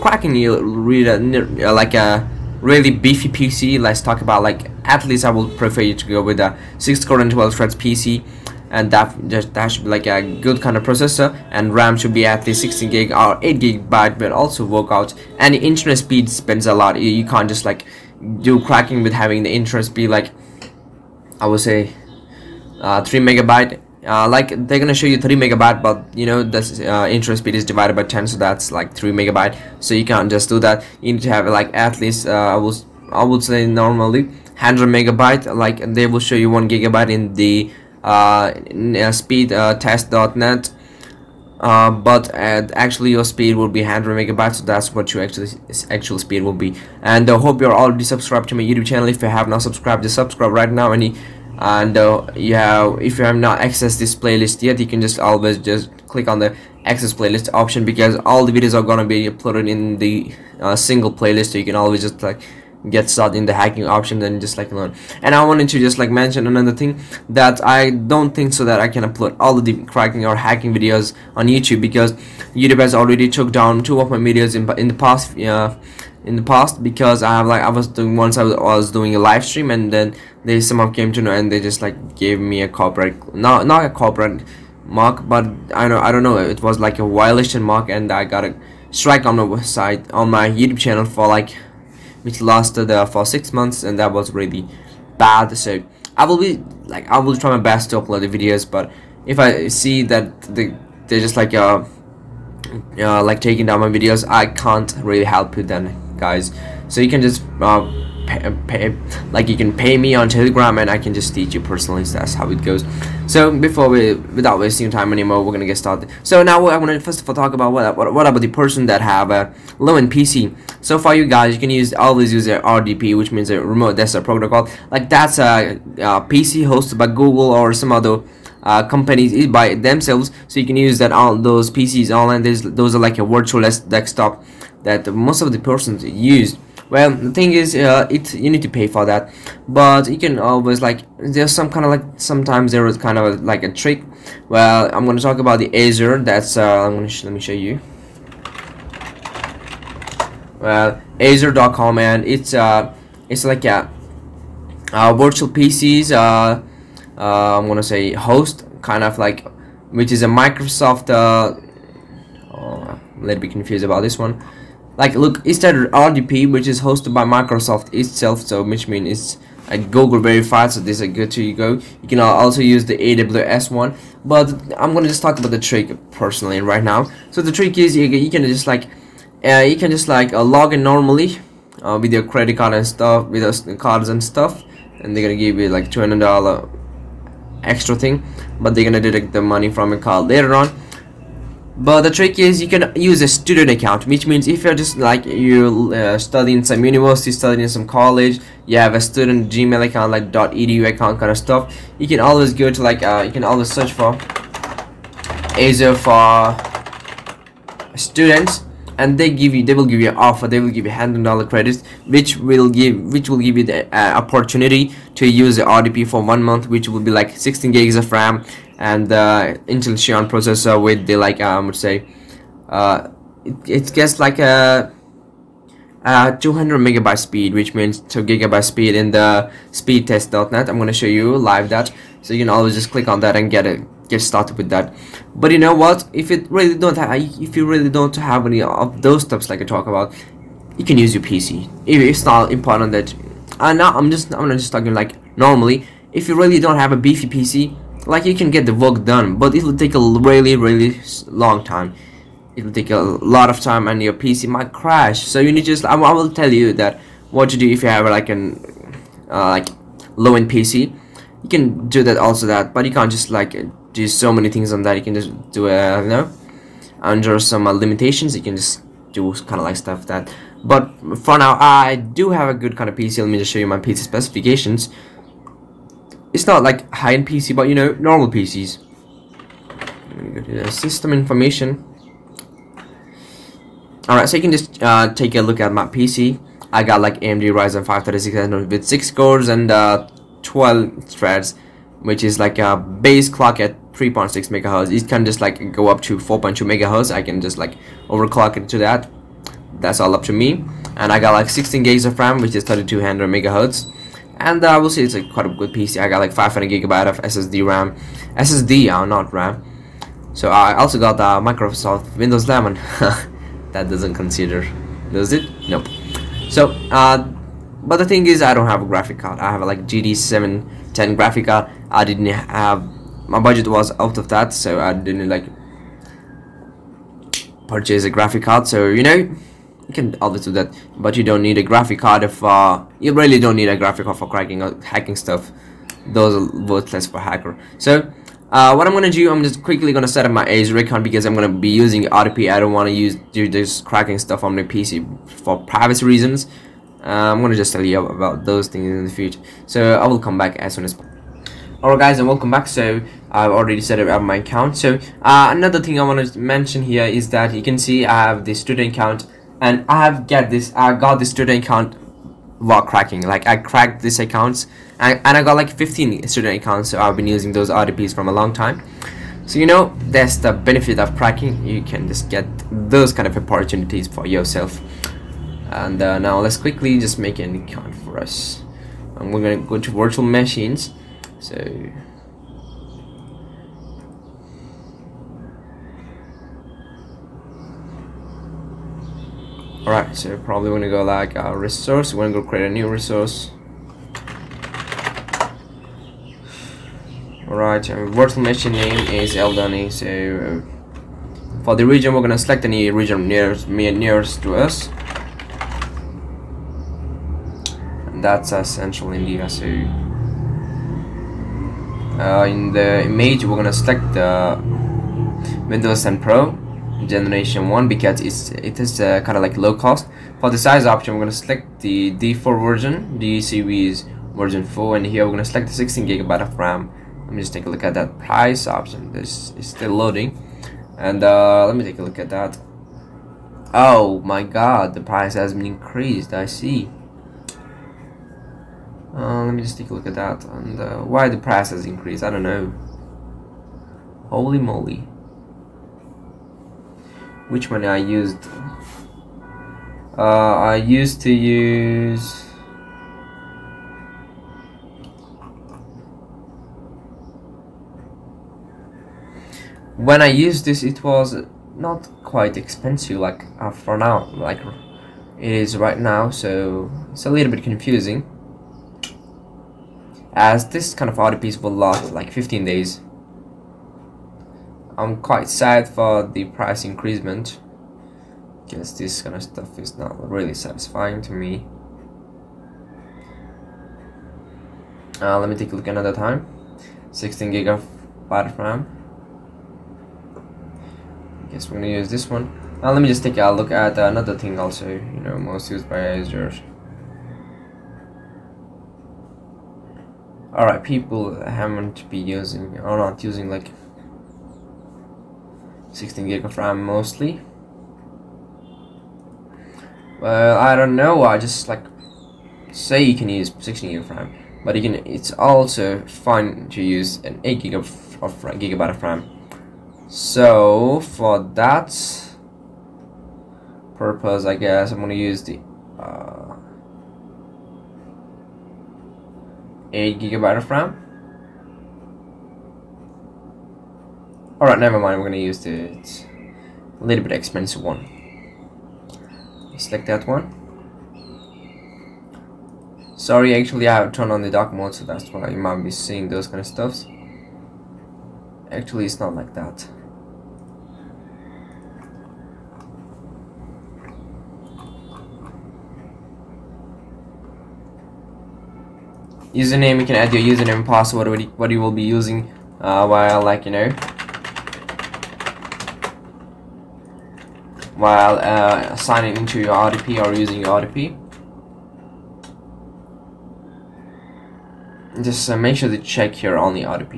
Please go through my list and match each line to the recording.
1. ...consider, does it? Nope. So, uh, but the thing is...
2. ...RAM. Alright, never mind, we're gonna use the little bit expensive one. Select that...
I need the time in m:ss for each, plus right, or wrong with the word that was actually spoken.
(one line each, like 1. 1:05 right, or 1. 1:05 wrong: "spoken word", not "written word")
1. 5:14 right
2. 8:50 right.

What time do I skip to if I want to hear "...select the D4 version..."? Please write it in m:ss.
7:01.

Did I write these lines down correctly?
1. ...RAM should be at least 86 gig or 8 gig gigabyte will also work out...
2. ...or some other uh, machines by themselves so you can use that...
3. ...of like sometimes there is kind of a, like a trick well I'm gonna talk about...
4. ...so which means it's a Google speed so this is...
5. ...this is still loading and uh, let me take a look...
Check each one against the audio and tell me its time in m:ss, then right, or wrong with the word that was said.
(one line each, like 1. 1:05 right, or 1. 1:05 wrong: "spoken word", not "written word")
1. 0:11 wrong: "16", not "86"
2. 2:07 wrong: "companies", not "machines"
3. 2:21 right
4. 2:48 wrong: "verified", not "speed"
5. 7:09 right.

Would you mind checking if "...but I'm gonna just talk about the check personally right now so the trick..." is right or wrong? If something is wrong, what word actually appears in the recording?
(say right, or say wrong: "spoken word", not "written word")
wrong: "trick", not "check".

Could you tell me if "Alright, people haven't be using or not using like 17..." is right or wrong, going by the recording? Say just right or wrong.
wrong.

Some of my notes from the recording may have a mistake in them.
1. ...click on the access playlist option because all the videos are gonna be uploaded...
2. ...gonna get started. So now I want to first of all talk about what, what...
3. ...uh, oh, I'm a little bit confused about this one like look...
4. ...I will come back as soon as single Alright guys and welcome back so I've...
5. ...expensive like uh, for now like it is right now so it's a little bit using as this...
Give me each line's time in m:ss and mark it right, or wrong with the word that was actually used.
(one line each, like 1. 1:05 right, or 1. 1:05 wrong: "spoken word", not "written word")
1. 0:56 right
2. 1:55 right
3. 2:41 right
4. 5:49 wrong: "possible", not "single"
5. 7:42 wrong: "confusing", not "using".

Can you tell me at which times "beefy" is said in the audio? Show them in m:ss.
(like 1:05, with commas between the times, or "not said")
0:02, 4:06.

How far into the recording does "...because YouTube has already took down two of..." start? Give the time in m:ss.
1:11.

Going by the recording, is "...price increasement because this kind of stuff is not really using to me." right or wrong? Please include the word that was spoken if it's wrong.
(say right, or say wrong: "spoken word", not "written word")
wrong: "satisfying", not "using".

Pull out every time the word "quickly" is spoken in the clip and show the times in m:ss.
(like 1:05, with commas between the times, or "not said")
5:39, 6:16.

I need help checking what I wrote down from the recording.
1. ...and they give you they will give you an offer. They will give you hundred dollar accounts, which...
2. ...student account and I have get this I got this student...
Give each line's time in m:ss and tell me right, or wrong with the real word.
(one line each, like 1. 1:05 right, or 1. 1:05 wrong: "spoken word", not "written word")
1. 3:28 wrong: "credits", not "accounts"
2. 5:58 right.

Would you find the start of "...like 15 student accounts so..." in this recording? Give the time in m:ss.
6:05.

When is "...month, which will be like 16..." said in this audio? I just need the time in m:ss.
3:36.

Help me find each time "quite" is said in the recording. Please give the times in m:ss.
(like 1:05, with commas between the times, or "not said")
5:05, 7:42, 7:55.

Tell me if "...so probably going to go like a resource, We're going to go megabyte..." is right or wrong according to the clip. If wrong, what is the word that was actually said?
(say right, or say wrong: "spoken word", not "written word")
wrong: "create", not "megabyte".